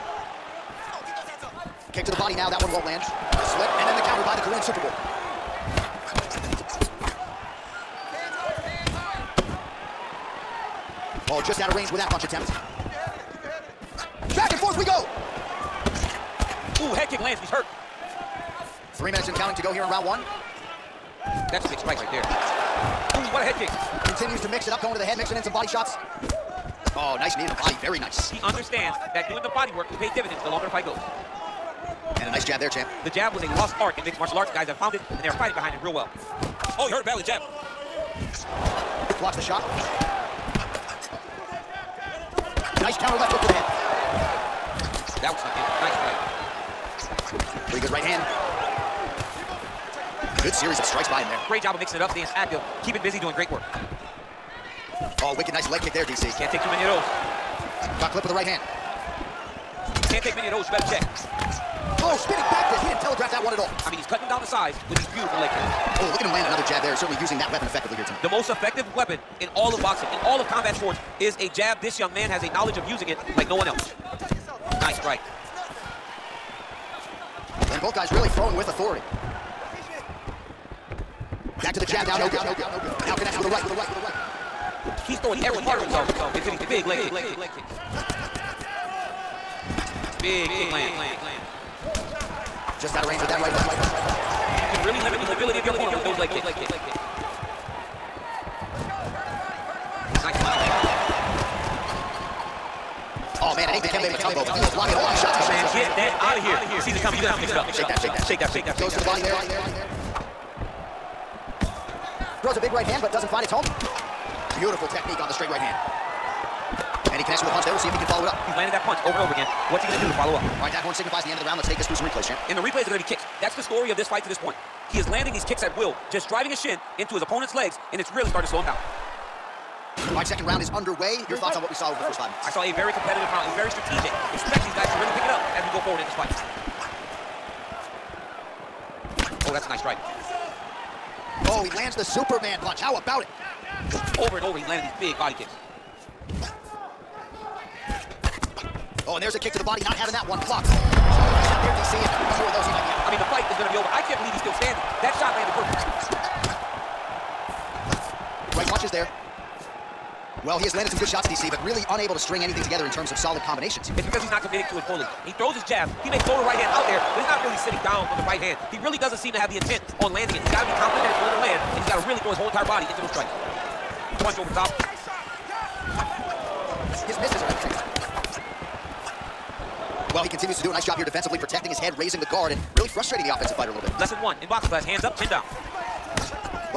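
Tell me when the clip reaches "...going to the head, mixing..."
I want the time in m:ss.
0:24.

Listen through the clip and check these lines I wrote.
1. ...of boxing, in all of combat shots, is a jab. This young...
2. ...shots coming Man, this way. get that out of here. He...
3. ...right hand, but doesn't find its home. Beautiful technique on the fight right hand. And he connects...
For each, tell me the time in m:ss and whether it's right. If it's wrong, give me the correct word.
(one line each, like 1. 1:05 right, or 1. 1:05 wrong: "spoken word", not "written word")
1. 1:09 wrong: "sports", not "shots"
2. 1:45 right
3. 1:52 wrong: "straight", not "fight".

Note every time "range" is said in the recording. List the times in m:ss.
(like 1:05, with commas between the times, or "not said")
0:11, 1:33.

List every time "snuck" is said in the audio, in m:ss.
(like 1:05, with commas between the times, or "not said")
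0:47.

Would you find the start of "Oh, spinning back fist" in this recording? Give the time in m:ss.
1:02.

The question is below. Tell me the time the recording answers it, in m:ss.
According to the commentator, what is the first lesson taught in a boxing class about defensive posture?
3:04.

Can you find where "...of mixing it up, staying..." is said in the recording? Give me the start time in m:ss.
0:51.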